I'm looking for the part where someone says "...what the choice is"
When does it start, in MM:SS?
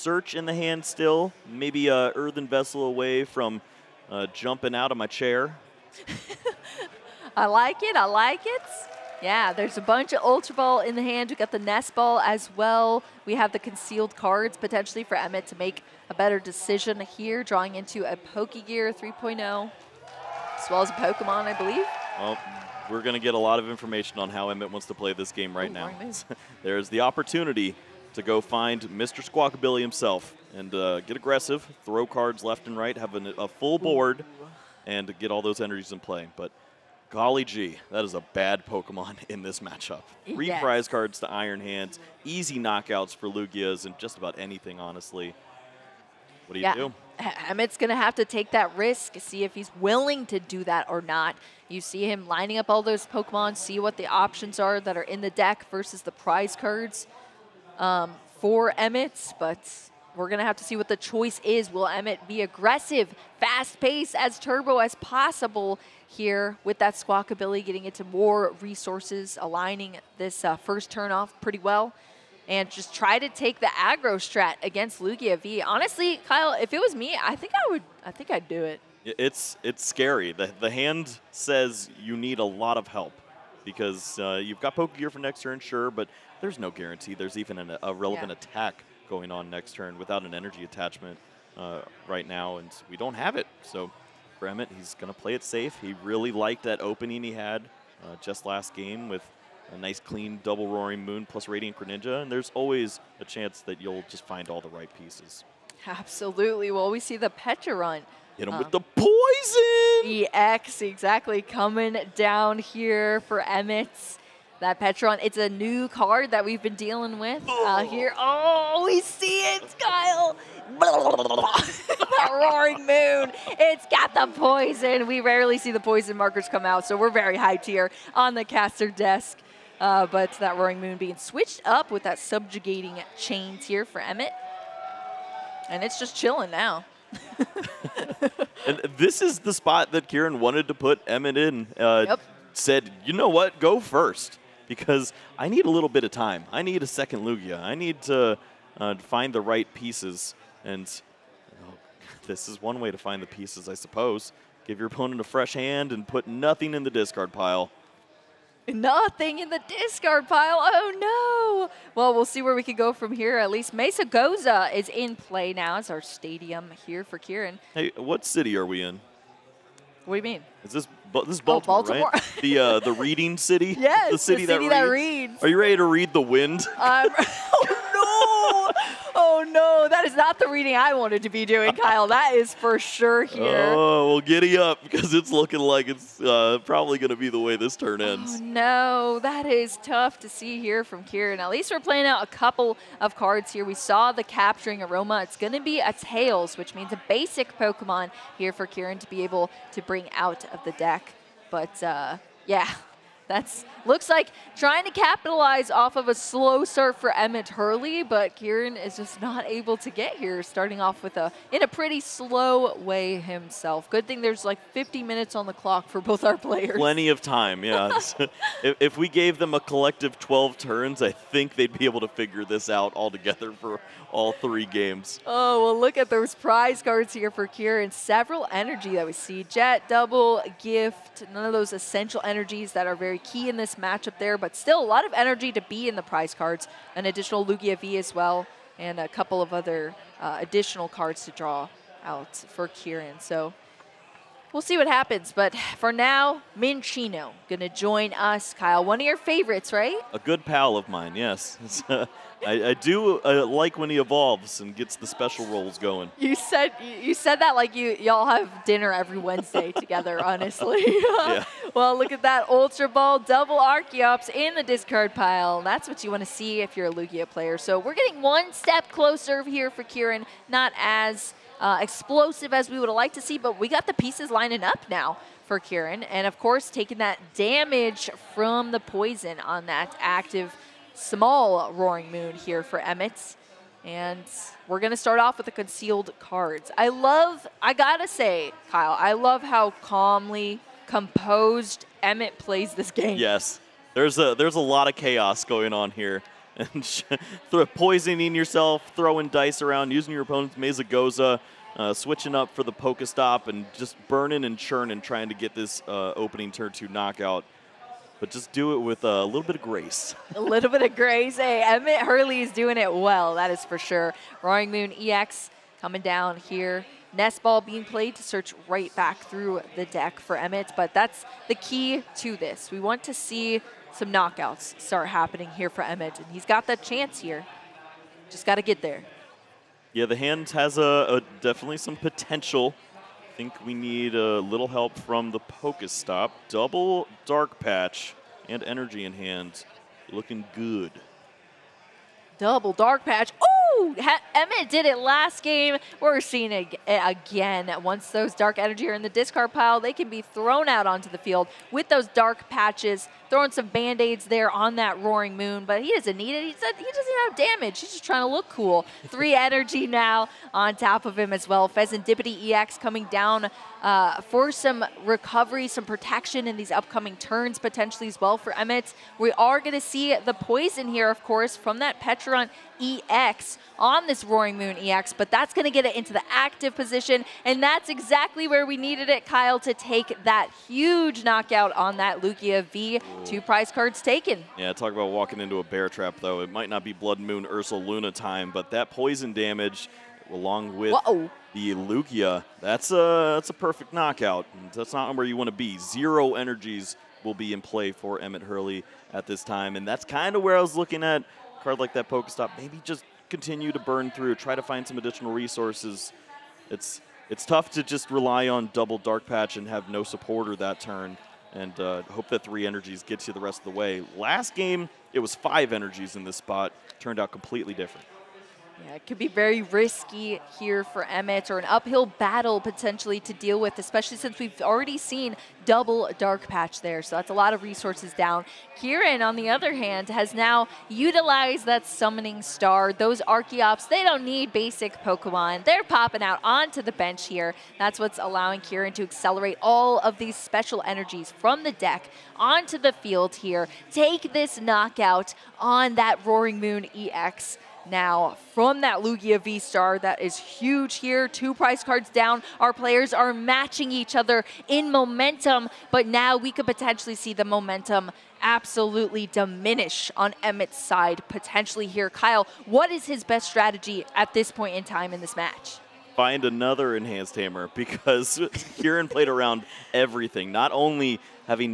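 01:00.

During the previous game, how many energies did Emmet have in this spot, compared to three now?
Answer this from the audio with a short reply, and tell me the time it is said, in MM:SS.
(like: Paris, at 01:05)
5, at 06:55.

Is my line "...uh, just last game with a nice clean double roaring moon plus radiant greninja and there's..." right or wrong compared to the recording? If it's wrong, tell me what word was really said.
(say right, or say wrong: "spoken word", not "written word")
right.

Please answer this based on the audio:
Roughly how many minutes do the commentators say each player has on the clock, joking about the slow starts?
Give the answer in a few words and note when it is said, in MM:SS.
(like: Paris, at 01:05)
50, at 03:34.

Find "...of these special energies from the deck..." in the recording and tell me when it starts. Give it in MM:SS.
07:20.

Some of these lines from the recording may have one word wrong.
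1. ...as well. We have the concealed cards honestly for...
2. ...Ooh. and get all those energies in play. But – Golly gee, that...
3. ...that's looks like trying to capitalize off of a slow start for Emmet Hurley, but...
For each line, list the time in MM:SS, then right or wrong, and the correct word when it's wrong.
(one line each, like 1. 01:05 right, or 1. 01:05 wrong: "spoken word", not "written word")
1. 00:12 wrong: "potentially", not "honestly"
2. 00:34 right
3. 03:23 right.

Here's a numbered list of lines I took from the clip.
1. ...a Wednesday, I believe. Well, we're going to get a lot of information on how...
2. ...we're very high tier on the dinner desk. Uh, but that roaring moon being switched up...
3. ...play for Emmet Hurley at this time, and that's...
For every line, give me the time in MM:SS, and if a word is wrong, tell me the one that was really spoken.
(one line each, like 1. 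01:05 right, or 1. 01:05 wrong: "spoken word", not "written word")
1. 00:20 wrong: "Pokemon", not "Wednesday"
2. 02:06 wrong: "caster", not "dinner"
3. 06:37 right.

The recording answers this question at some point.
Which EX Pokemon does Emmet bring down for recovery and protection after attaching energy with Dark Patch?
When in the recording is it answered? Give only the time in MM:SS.
06:01.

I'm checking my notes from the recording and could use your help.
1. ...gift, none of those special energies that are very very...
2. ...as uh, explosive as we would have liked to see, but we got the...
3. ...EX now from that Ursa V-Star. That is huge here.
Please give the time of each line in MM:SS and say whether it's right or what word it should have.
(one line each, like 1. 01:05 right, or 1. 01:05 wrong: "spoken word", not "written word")
1. 03:50 wrong: "essential", not "special"
2. 04:30 right
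3. 07:26 wrong: "Lugia", not "Ursa".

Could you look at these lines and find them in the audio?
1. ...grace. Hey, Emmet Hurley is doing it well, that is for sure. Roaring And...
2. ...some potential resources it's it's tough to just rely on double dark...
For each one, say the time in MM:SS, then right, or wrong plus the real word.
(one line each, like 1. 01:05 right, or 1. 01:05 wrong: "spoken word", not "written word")
1. 05:10 wrong: "Moon", not "And"
2. 06:44 wrong: "additional", not "potential".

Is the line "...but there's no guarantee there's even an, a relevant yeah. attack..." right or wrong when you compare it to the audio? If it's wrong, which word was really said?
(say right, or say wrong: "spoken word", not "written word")
right.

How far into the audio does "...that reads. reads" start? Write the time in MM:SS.
02:54.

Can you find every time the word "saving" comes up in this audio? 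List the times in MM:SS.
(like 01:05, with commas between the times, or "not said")
not said.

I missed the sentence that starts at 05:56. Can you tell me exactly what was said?
He doesn't, he doesn't have damage.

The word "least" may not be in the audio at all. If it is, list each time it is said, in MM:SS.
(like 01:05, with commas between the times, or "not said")
02:43, 03:11.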